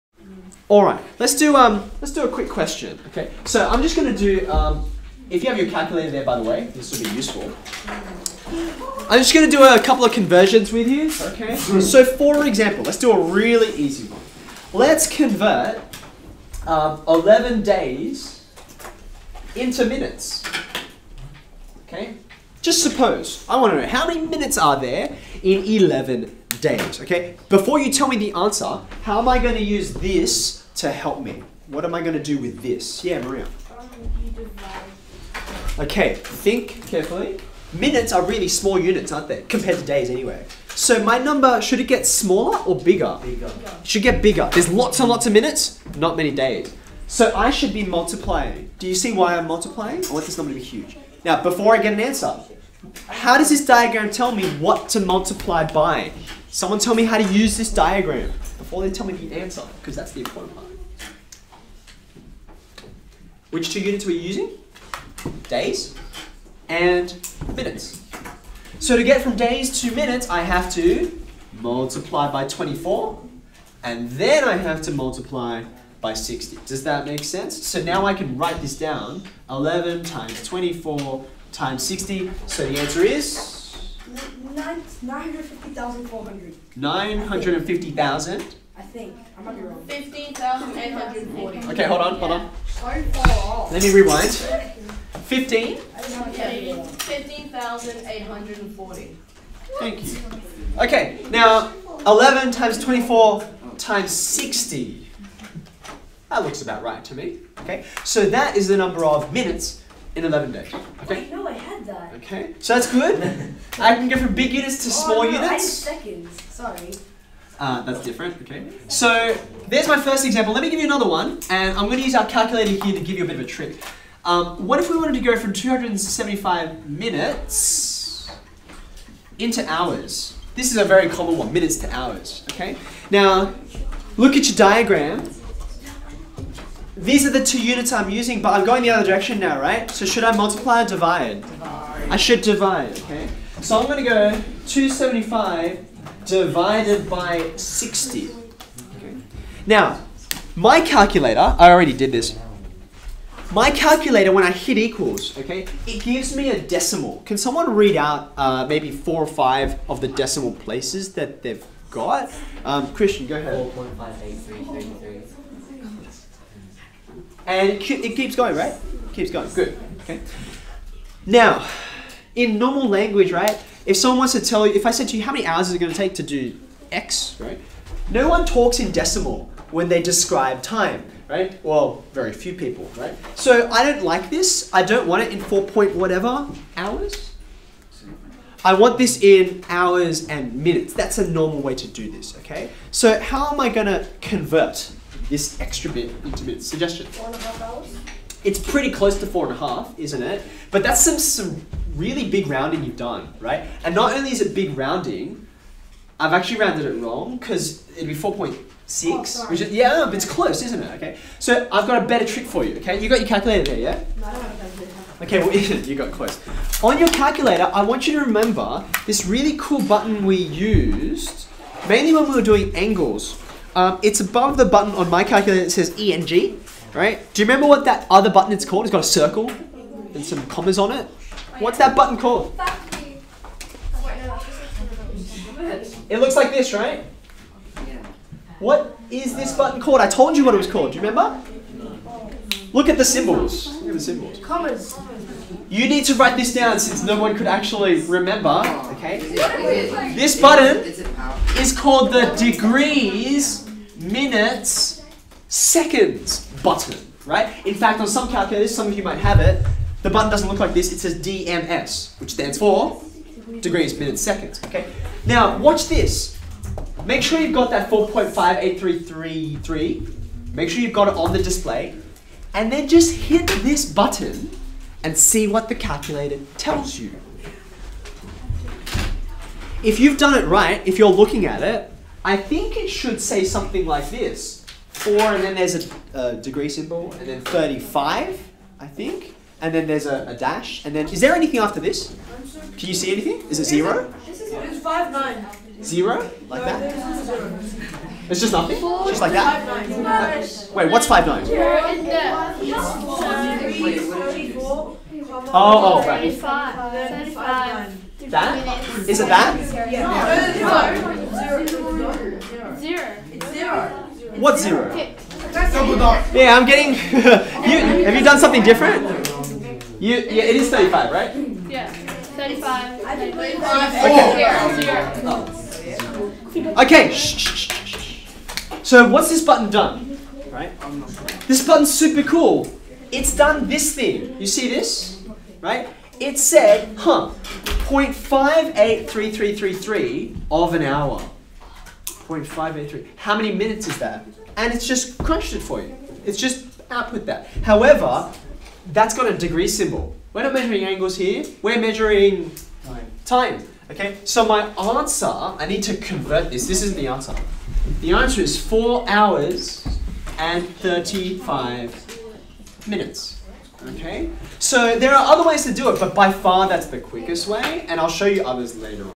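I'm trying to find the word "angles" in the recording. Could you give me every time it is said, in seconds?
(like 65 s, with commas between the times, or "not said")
222 s, 350 s.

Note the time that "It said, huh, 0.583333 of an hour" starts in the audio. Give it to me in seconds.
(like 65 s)
336 s.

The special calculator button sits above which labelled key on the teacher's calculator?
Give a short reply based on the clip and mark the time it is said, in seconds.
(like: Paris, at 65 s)
ENG, at 225 s.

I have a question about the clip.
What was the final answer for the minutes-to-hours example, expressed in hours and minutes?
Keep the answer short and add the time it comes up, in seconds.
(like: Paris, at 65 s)
4 hours and 35 minutes, at 358 s.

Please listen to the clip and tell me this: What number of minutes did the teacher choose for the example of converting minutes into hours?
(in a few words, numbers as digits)
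275.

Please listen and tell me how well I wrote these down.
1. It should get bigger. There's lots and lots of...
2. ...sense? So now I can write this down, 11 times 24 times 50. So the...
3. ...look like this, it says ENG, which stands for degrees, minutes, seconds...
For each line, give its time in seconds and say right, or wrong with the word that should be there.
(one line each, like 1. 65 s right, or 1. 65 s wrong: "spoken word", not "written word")
1. 43 s right
2. 77 s wrong: "60", not "50"
3. 260 s wrong: "DMS", not "ENG".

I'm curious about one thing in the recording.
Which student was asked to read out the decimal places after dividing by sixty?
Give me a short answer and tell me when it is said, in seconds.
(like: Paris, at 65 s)
Christian, at 162 s.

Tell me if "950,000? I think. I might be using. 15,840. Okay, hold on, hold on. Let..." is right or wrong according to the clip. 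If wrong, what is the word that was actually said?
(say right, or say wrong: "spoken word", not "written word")
wrong: "wrong", not "using".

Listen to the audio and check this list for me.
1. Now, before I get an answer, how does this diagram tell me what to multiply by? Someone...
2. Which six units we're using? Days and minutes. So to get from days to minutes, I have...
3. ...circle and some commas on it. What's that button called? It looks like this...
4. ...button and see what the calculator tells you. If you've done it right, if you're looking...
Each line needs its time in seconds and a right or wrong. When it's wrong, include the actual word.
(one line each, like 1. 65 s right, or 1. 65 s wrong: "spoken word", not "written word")
1. 51 s right
2. 63 s wrong: "two", not "six"
3. 229 s right
4. 273 s right.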